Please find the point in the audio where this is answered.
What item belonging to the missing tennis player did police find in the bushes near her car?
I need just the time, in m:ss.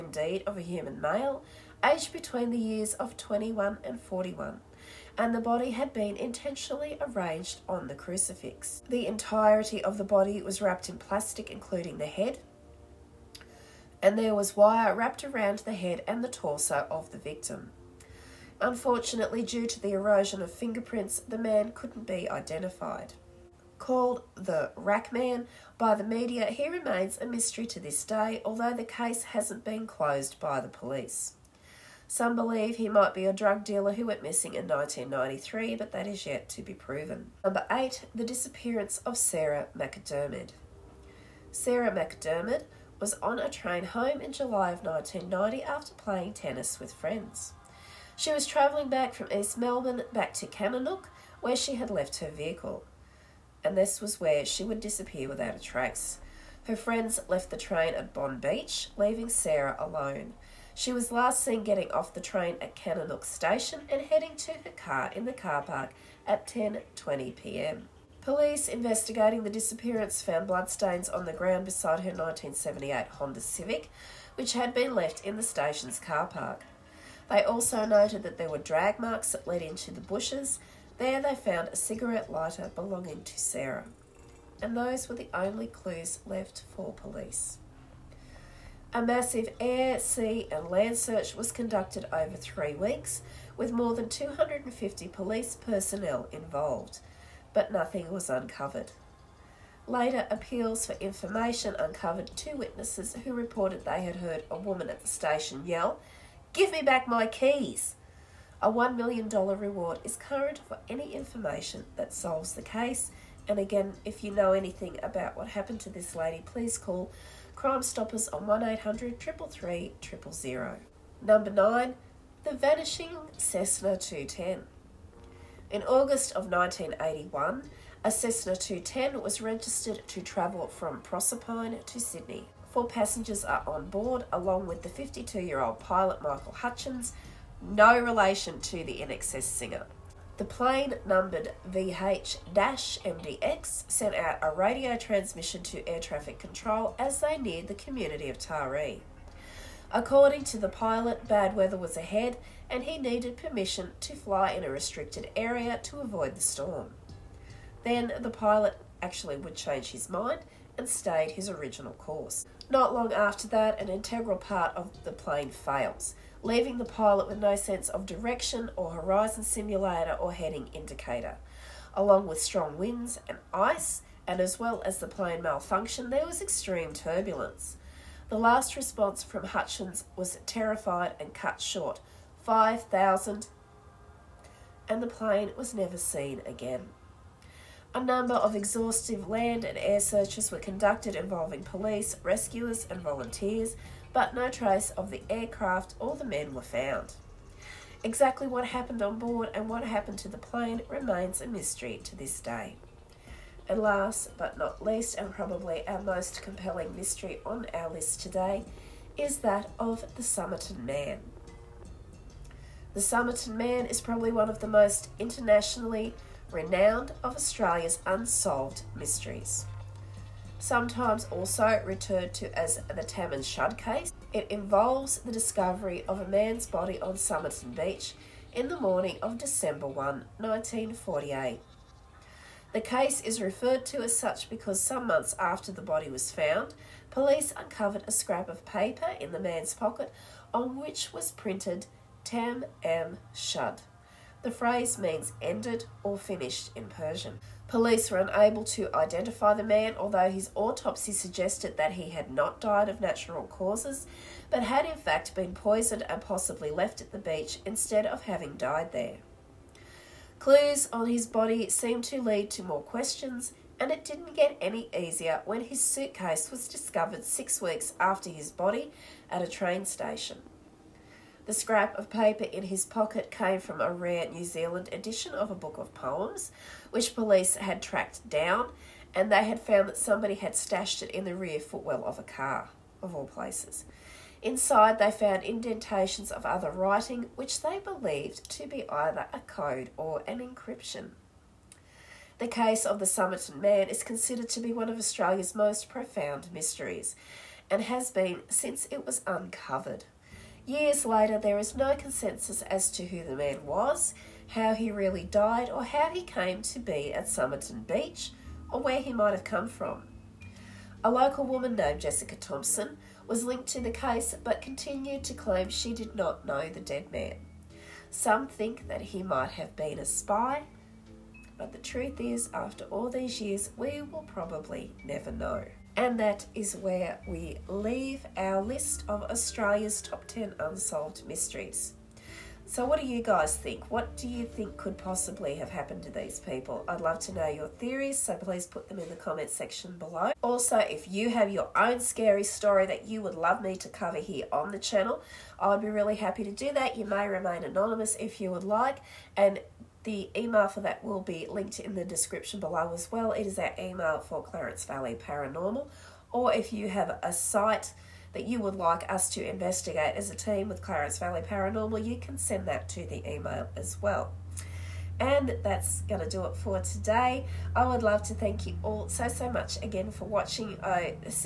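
1:21.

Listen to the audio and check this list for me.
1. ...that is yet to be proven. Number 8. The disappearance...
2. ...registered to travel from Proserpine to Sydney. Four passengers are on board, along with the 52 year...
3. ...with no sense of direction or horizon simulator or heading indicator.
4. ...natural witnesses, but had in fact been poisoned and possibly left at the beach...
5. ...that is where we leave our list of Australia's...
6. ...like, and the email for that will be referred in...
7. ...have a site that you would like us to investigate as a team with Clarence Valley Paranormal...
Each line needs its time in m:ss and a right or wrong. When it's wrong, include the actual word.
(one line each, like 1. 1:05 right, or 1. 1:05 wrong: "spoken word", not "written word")
1. 0:35 right
2. 2:09 right
3. 2:47 right
4. 4:13 wrong: "causes", not "witnesses"
5. 5:26 right
6. 5:48 wrong: "linked", not "referred"
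7. 5:56 right.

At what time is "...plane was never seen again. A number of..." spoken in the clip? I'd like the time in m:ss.
3:05.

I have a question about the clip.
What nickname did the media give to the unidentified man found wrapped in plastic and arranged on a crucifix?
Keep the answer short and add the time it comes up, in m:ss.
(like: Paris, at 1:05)
The Rack Man, at 0:24.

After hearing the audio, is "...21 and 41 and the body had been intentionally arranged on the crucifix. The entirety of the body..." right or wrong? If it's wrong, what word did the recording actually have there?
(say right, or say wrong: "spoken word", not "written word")
right.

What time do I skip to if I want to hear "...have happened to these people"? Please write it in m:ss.
5:35.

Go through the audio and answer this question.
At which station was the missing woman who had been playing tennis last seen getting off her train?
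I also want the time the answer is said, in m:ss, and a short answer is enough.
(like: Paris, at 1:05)
Kenilworth, at 1:02.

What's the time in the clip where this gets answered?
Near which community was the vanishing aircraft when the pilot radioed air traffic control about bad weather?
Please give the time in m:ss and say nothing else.
2:28.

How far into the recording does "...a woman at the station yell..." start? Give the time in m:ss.
1:44.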